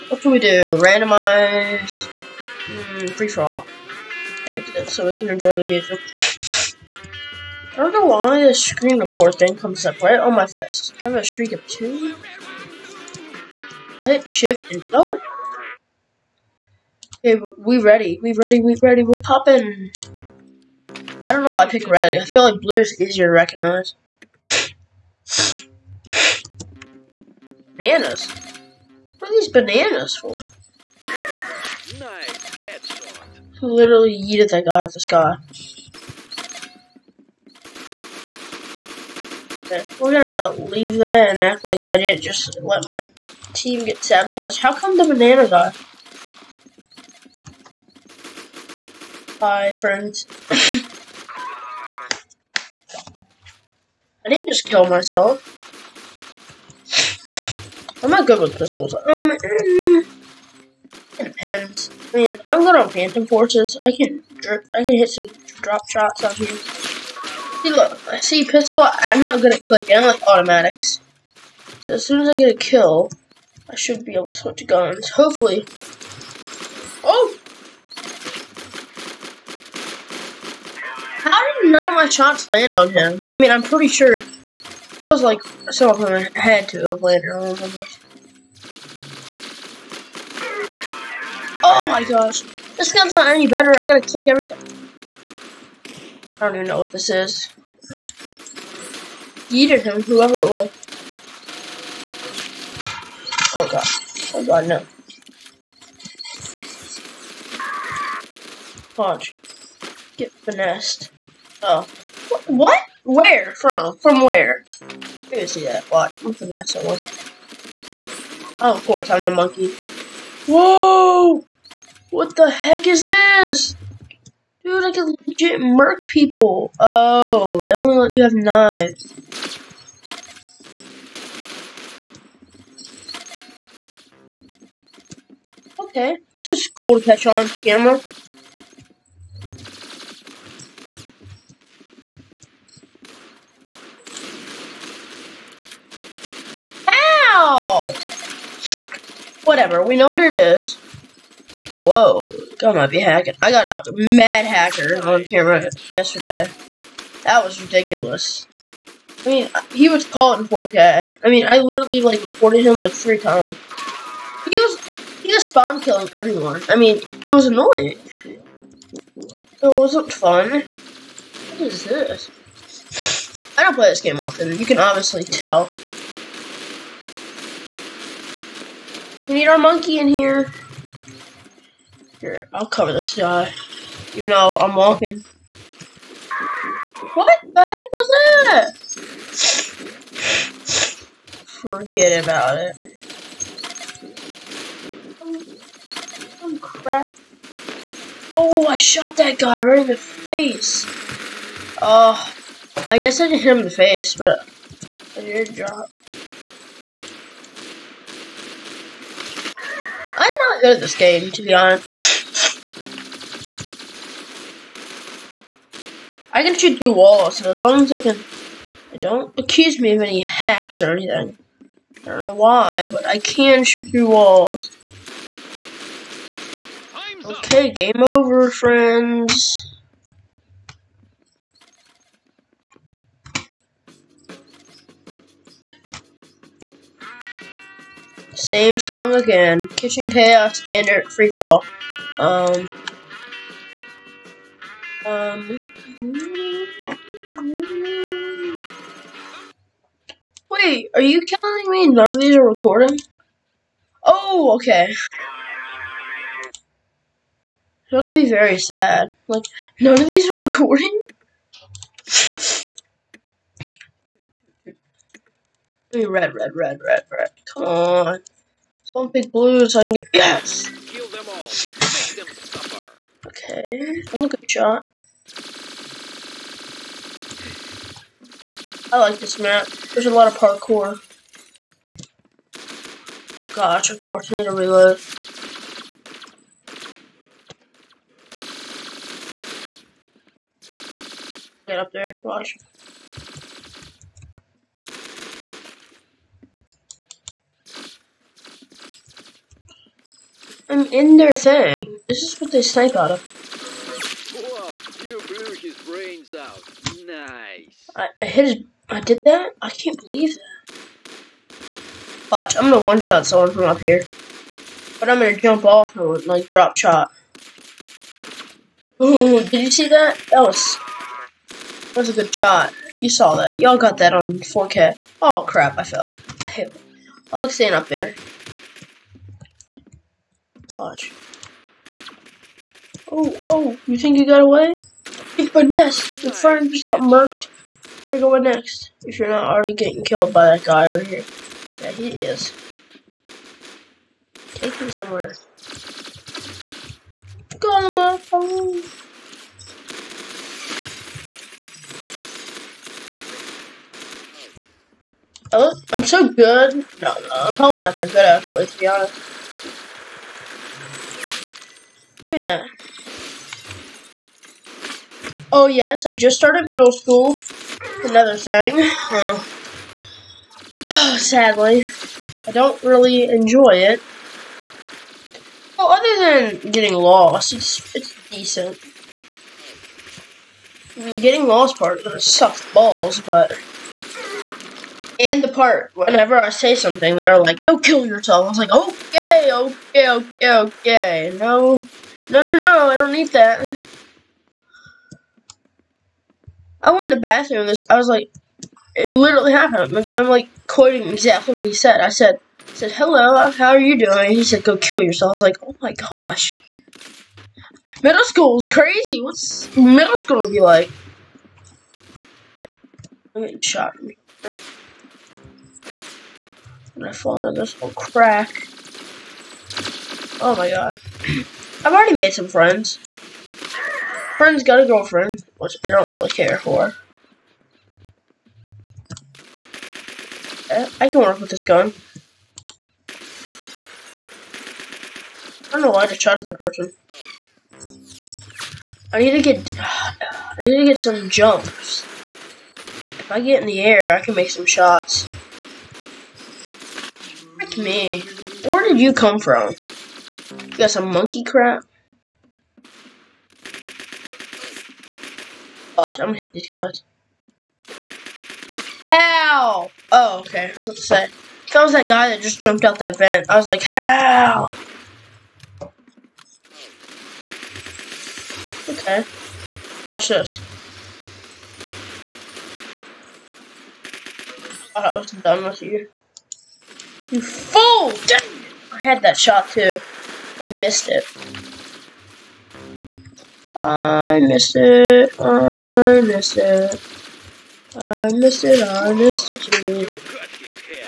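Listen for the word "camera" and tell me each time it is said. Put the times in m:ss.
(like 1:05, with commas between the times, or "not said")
2:17, 2:35.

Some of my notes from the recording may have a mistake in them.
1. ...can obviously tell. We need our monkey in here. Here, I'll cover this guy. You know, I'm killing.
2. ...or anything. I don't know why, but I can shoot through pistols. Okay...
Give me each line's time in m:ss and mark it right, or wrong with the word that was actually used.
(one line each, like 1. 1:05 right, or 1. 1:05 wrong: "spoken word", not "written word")
1. 2:54 wrong: "walking", not "killing"
2. 3:40 wrong: "walls", not "pistols".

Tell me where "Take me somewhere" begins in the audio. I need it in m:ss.
5:44.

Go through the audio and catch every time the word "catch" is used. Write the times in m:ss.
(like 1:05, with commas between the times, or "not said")
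0:32, 2:17.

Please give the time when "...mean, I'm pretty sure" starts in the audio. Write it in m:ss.
1:23.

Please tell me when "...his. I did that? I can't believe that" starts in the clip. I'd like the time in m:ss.
5:08.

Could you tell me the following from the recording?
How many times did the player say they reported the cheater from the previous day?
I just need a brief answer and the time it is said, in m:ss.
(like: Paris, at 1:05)
3, at 2:42.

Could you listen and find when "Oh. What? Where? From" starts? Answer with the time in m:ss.
1:51.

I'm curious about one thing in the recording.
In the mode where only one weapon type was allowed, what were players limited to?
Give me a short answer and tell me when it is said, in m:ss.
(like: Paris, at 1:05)
Knives, at 2:08.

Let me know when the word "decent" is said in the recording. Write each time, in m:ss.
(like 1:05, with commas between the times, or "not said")
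6:18.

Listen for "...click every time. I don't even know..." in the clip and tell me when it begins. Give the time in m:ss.
1:34.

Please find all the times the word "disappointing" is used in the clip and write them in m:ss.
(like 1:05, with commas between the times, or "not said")
not said.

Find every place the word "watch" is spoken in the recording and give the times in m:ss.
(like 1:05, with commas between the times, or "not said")
4:52, 5:12, 7:50.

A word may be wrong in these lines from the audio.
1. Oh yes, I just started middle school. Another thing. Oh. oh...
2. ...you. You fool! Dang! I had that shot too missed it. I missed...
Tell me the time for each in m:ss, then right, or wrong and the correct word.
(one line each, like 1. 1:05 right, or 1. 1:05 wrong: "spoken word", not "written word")
1. 6:05 right
2. 7:55 right.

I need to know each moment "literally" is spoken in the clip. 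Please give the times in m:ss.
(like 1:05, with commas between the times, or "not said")
0:33, 2:41, 6:39.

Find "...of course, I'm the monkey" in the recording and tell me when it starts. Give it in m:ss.
1:58.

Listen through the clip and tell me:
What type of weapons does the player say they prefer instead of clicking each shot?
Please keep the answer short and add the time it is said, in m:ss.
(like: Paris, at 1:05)
Automatics, at 1:10.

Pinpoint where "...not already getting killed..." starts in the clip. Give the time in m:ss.
5:39.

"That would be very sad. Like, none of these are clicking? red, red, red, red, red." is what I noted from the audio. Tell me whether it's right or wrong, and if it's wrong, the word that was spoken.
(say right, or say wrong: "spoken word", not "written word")
wrong: "recording", not "clicking".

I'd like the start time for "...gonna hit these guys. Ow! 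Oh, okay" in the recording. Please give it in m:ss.
7:36.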